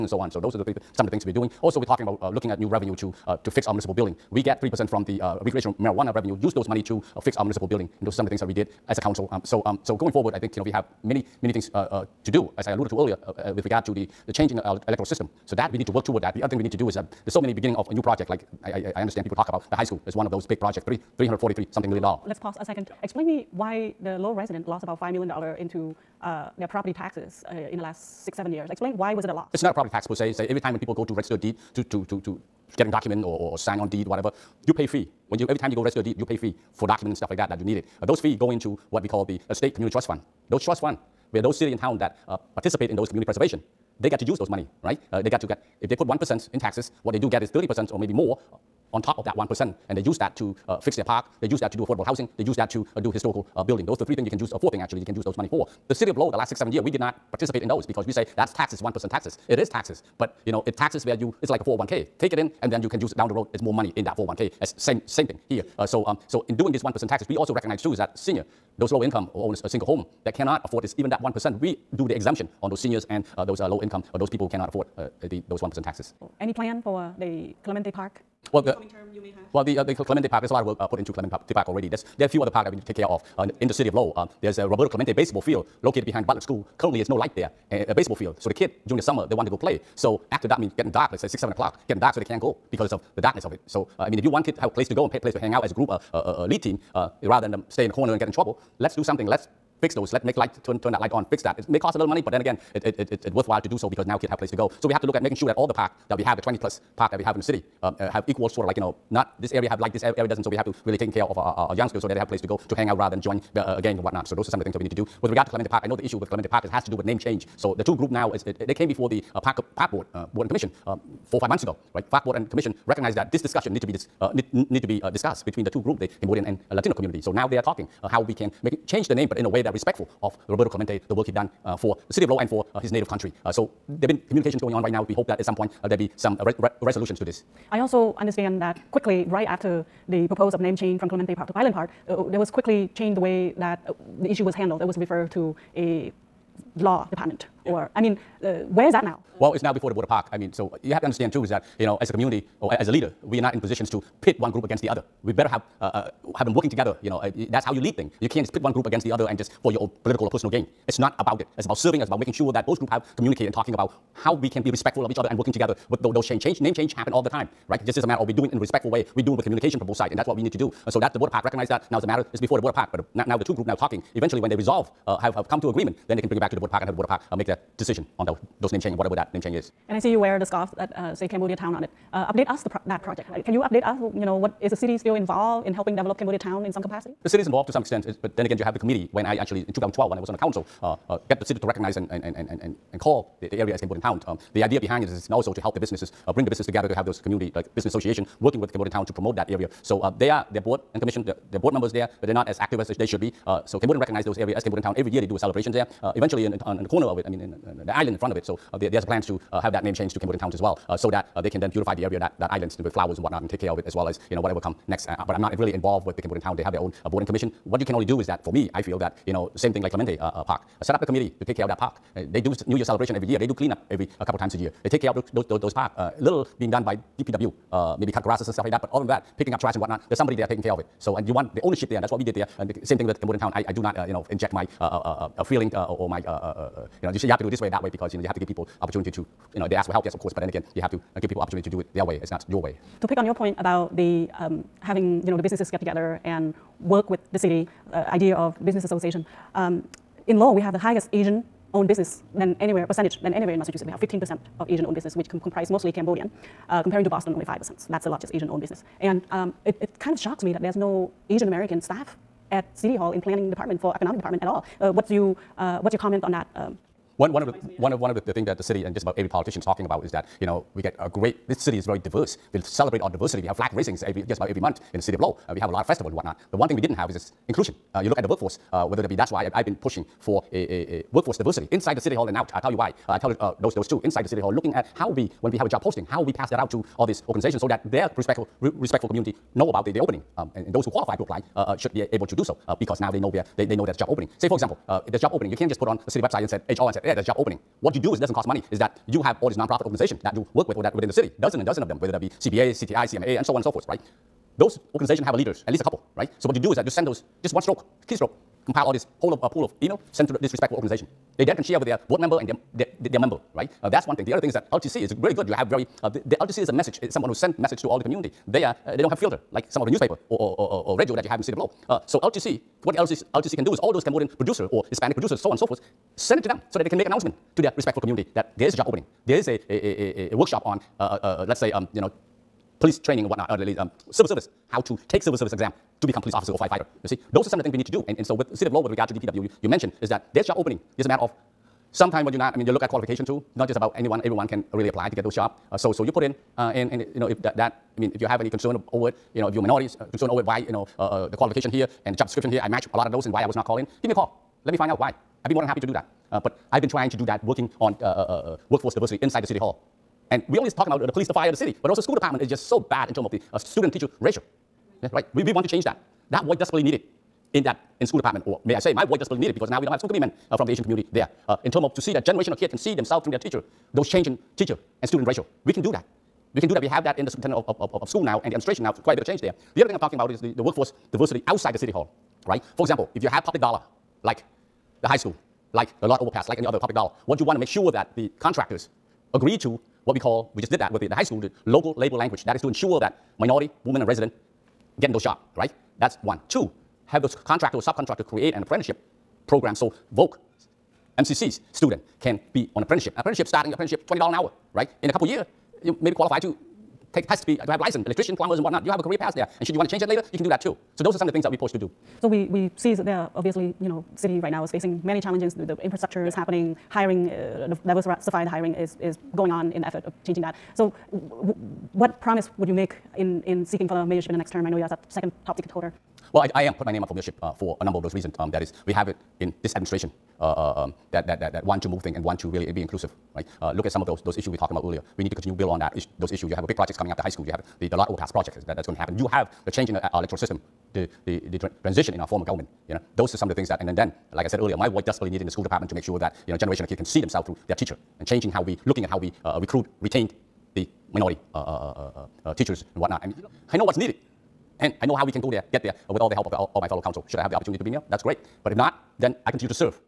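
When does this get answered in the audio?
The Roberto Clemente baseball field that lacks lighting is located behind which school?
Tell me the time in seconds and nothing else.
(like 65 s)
86 s.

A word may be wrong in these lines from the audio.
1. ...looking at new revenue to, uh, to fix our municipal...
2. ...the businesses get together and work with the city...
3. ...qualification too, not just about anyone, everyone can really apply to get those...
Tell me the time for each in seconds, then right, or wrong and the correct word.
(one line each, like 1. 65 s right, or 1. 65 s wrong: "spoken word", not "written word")
1. 2 s right
2. 245 s right
3. 342 s right.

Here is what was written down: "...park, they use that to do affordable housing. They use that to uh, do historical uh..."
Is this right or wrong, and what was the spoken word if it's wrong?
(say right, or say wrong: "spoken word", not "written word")
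right.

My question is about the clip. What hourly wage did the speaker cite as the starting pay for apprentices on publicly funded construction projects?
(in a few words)
$20 an hour.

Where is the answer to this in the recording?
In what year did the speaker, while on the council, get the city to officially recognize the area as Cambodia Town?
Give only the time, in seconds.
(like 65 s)
189 s.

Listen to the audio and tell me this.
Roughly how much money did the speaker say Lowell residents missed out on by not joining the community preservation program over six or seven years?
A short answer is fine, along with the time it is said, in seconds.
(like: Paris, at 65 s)
$5 million, at 25 s.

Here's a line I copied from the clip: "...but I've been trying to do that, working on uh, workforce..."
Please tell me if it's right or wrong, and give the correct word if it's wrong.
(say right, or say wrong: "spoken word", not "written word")
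right.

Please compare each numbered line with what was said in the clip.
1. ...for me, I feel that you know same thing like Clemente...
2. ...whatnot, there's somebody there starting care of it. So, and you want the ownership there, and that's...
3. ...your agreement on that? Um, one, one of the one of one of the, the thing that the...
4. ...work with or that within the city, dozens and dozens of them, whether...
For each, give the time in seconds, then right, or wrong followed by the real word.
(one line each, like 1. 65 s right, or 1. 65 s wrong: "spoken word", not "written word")
1. 218 s right
2. 229 s wrong: "taking", not "starting"
3. 265 s wrong: "comment", not "agreement"
4. 300 s right.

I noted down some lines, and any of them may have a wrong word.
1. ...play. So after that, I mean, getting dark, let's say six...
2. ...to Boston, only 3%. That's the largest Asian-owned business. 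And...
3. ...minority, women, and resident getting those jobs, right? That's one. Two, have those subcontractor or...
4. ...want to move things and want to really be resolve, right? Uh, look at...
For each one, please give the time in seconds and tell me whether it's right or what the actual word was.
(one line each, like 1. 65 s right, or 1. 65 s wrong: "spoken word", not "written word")
1. 89 s right
2. 257 s wrong: "5", not "3"
3. 393 s wrong: "contractor", not "subcontractor"
4. 431 s wrong: "inclusive", not "resolve".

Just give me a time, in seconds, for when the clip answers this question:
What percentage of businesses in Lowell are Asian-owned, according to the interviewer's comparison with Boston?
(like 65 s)
253 s.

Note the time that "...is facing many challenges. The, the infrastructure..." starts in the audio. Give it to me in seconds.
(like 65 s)
414 s.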